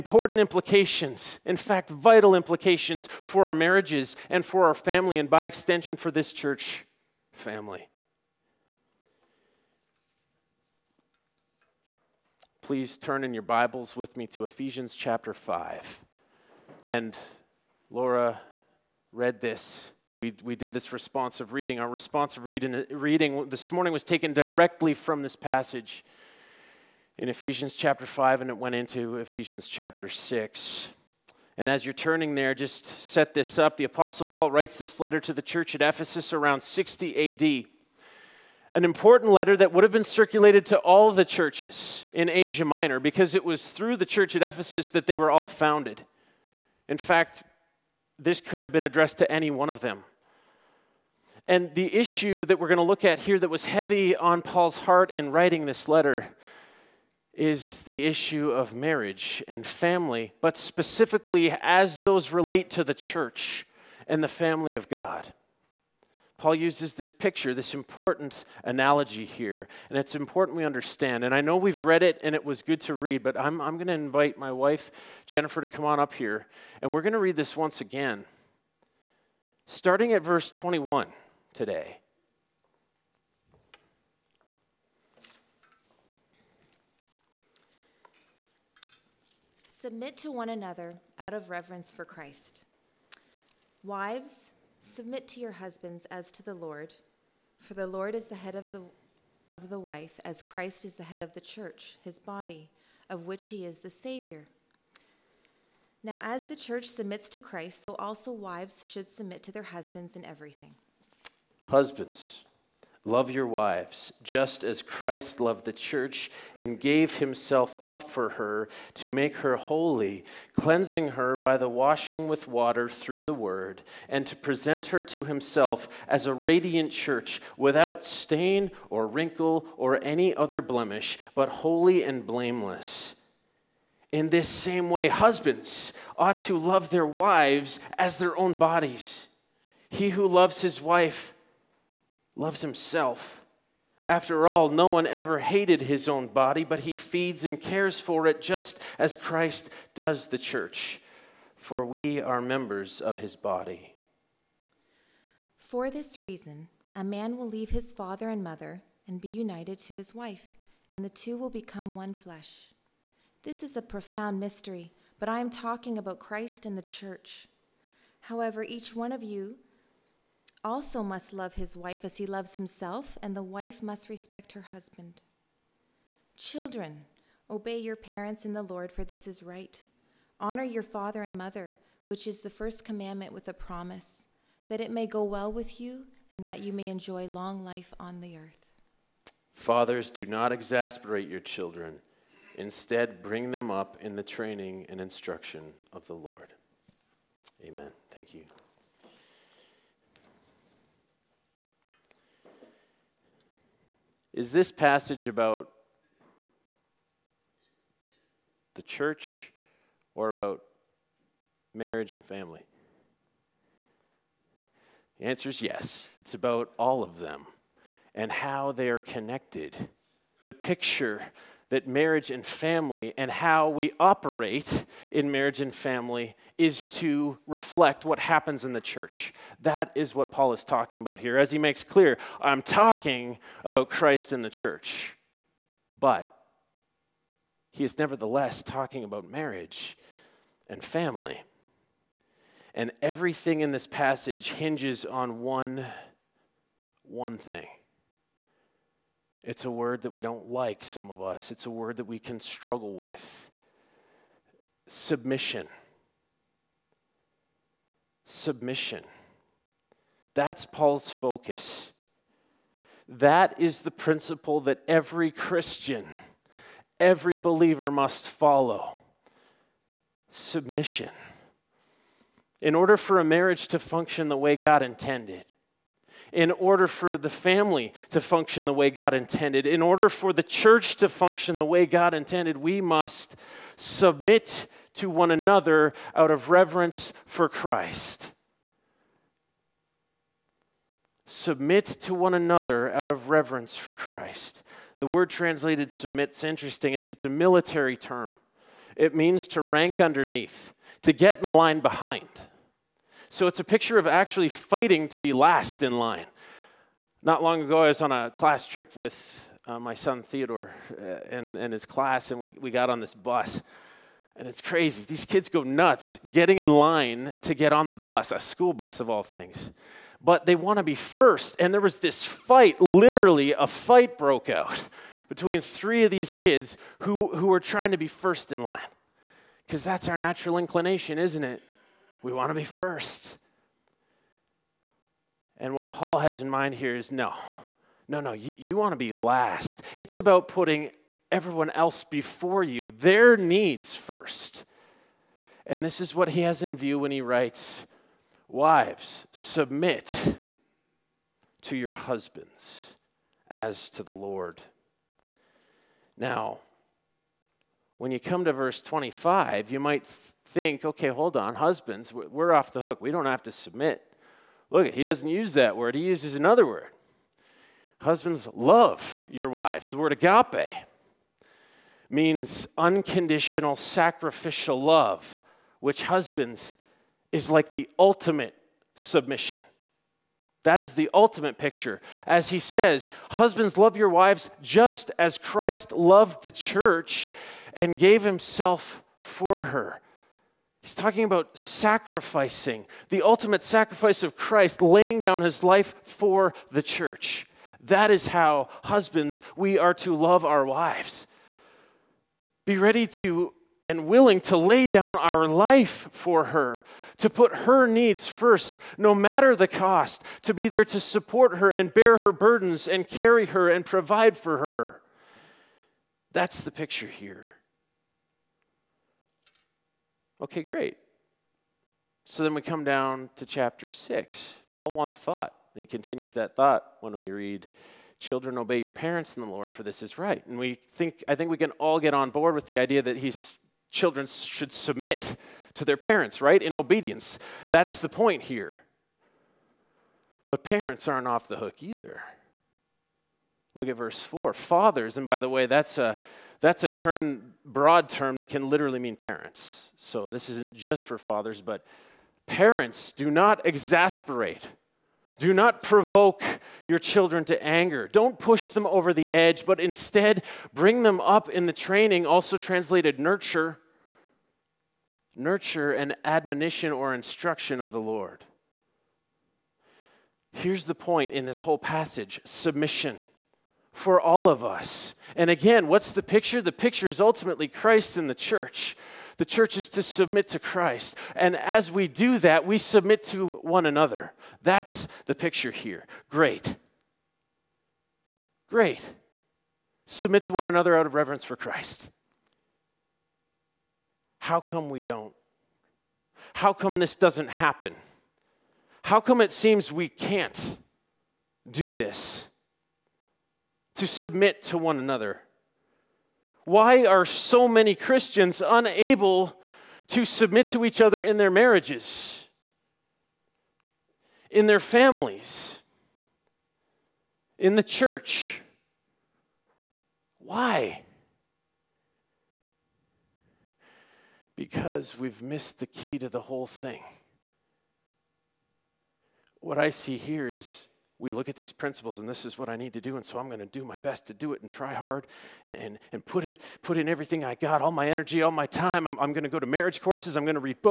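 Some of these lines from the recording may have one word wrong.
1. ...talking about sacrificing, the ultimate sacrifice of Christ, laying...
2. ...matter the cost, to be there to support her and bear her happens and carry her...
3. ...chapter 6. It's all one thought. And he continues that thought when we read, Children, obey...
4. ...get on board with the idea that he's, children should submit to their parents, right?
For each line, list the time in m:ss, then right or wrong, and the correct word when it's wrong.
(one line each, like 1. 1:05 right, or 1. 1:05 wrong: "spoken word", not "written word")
1. 6:30 right
2. 6:49 wrong: "burdens", not "happens"
3. 7:03 right
4. 7:11 right.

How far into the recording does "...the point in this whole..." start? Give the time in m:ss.
7:50.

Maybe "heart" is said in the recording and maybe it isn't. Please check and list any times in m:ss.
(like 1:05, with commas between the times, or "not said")
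0:54.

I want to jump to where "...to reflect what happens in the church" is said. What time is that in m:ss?
3:46.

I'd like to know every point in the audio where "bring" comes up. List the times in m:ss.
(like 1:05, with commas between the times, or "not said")
3:13, 7:40.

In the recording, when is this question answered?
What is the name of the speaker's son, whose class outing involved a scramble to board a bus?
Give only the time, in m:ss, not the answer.
5:10.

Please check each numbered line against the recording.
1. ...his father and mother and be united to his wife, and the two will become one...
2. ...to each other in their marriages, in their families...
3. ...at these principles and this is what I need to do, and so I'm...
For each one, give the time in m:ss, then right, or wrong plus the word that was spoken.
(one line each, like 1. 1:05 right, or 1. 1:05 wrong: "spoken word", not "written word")
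1. 2:37 right
2. 8:30 right
3. 8:51 right.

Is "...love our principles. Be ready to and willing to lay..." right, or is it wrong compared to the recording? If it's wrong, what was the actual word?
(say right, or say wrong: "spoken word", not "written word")
wrong: "wives", not "principles".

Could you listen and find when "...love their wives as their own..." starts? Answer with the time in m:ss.
2:16.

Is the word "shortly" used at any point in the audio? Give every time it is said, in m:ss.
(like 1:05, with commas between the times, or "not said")
not said.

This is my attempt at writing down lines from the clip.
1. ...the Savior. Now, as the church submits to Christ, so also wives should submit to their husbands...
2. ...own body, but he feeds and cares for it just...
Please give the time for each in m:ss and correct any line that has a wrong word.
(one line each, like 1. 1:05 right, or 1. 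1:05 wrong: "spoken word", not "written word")
1. 1:43 right
2. 2:26 right.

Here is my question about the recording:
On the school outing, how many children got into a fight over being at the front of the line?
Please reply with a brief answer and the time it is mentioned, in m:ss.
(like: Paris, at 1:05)
3, at 5:25.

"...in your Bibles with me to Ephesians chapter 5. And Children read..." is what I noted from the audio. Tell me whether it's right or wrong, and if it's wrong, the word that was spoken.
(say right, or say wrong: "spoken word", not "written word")
wrong: "Laura", not "Children".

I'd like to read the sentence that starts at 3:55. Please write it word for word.
But he is nevertheless talking about marriage and family.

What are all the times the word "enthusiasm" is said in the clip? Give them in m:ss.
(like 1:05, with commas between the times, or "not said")
not said.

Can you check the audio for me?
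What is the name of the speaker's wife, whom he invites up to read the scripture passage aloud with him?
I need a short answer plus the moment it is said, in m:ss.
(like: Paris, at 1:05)
Jennifer, at 1:15.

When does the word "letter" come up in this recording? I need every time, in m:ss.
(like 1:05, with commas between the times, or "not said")
0:34, 0:39, 0:55.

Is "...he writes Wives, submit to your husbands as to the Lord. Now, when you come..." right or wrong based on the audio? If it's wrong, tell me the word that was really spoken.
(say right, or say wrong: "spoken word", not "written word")
right.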